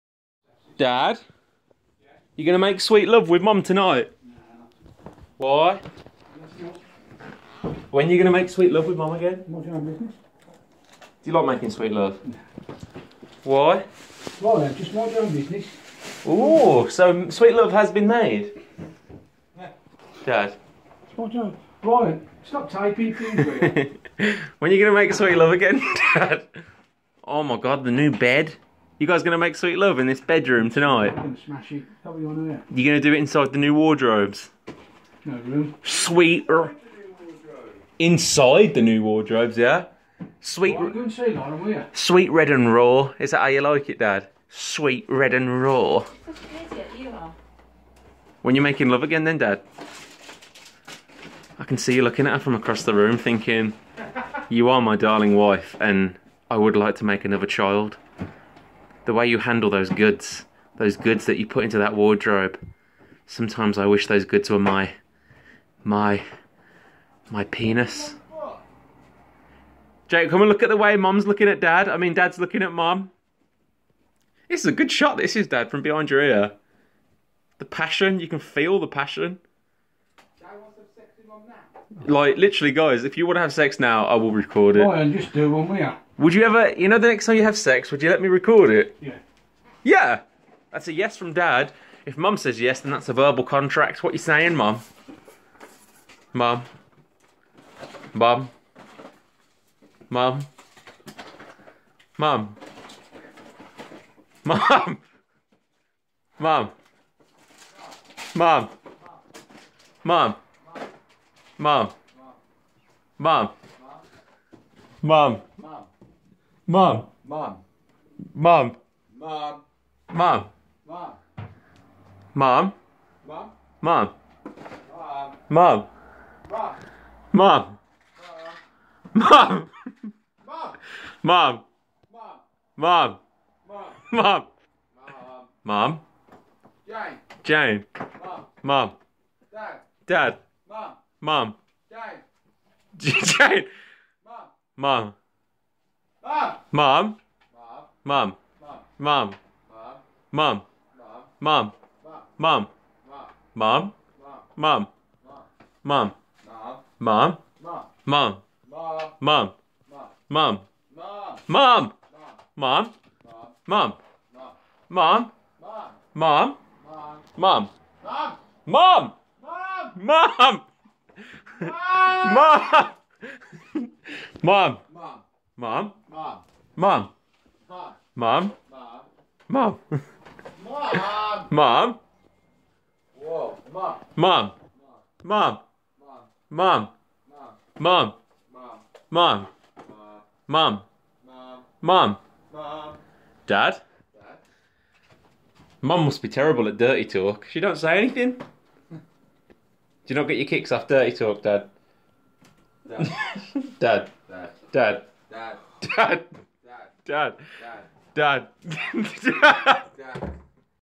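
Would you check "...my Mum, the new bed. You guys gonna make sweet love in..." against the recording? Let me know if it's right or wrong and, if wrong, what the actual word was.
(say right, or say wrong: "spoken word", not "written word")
wrong: "God", not "Mum".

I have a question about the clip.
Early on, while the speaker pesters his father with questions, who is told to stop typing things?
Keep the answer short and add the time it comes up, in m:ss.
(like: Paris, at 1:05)
Ryan, at 0:21.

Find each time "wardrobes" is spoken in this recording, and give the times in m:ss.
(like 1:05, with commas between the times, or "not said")
0:33, 0:39, 1:01.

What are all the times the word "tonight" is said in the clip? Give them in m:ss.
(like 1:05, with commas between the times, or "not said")
0:03, 0:30.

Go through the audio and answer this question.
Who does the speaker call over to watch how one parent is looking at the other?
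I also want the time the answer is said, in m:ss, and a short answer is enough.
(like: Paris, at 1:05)
Jake, at 1:10.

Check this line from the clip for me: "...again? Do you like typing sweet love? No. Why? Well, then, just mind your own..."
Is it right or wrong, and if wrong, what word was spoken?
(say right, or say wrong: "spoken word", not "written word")
wrong: "making", not "typing".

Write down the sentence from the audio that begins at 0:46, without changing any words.
You when you're making love again, then, Dad.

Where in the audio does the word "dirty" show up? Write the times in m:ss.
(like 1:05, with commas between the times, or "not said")
3:16, 3:20.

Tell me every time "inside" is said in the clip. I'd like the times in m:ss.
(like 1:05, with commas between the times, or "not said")
0:33, 0:37.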